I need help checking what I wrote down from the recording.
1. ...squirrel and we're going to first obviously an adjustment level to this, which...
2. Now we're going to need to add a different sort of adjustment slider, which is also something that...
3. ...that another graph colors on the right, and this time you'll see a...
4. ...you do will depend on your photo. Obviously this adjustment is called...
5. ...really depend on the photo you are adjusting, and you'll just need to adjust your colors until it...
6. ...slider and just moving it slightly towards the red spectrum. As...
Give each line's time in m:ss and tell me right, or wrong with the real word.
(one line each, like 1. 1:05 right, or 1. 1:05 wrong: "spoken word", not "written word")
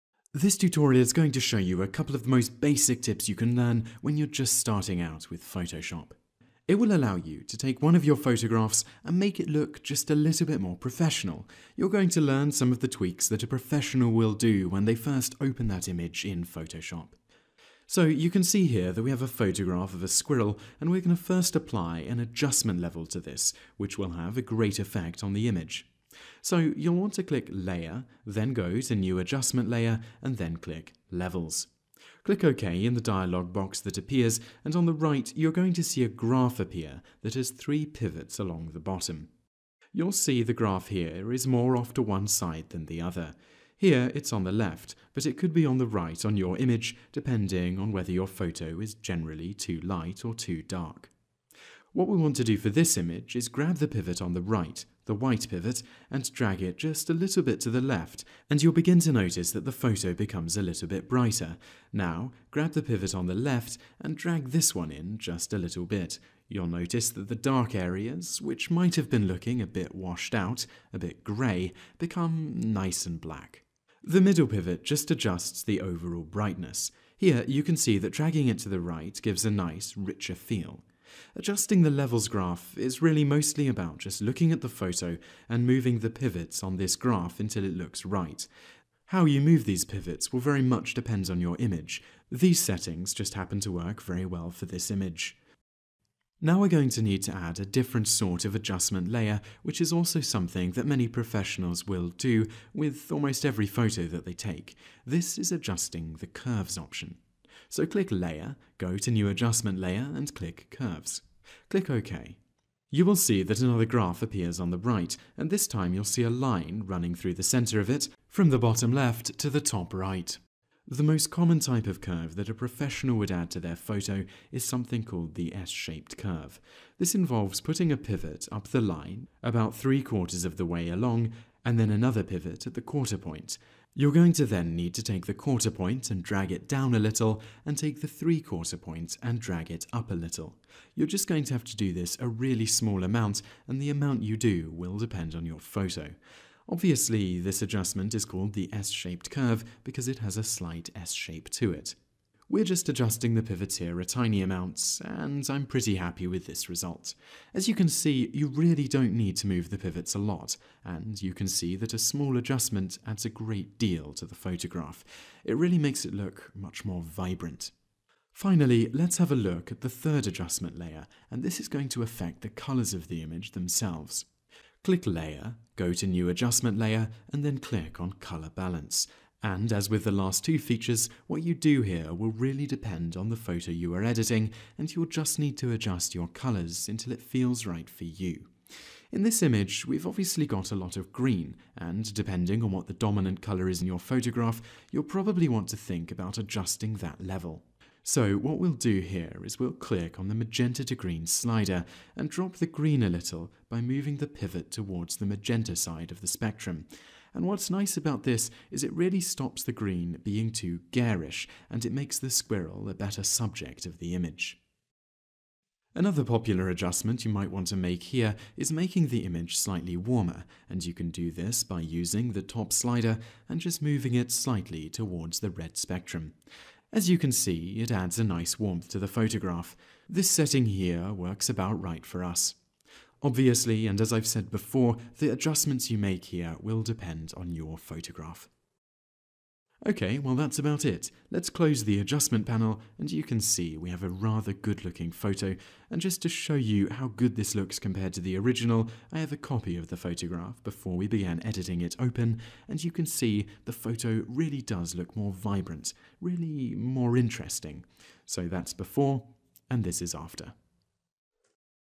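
1. 0:20 wrong: "apply", not "obviously"
2. 1:36 wrong: "layer", not "slider"
3. 1:53 wrong: "appears", not "colors"
4. 2:24 right
5. 3:02 wrong: "editing", not "adjusting"
6. 3:42 right.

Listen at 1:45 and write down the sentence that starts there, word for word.
This is adjusting the curves option.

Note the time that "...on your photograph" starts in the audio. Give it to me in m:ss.
3:57.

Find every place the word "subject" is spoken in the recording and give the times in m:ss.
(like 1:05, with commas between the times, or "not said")
3:33.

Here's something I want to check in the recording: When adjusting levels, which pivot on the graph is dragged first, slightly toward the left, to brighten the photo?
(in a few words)
The white pivot.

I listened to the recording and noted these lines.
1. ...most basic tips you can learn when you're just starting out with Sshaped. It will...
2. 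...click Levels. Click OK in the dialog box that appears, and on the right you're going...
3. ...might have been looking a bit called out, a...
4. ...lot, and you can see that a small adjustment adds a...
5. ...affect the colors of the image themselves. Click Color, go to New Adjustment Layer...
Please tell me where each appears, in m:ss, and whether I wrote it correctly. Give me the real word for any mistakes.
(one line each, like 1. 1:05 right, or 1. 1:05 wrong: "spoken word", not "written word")
1. 0:02 wrong: "Photoshop", not "Sshaped"
2. 0:30 right
3. 1:08 wrong: "washed", not "called"
4. 2:40 right
5. 2:52 wrong: "Layer", not "Color".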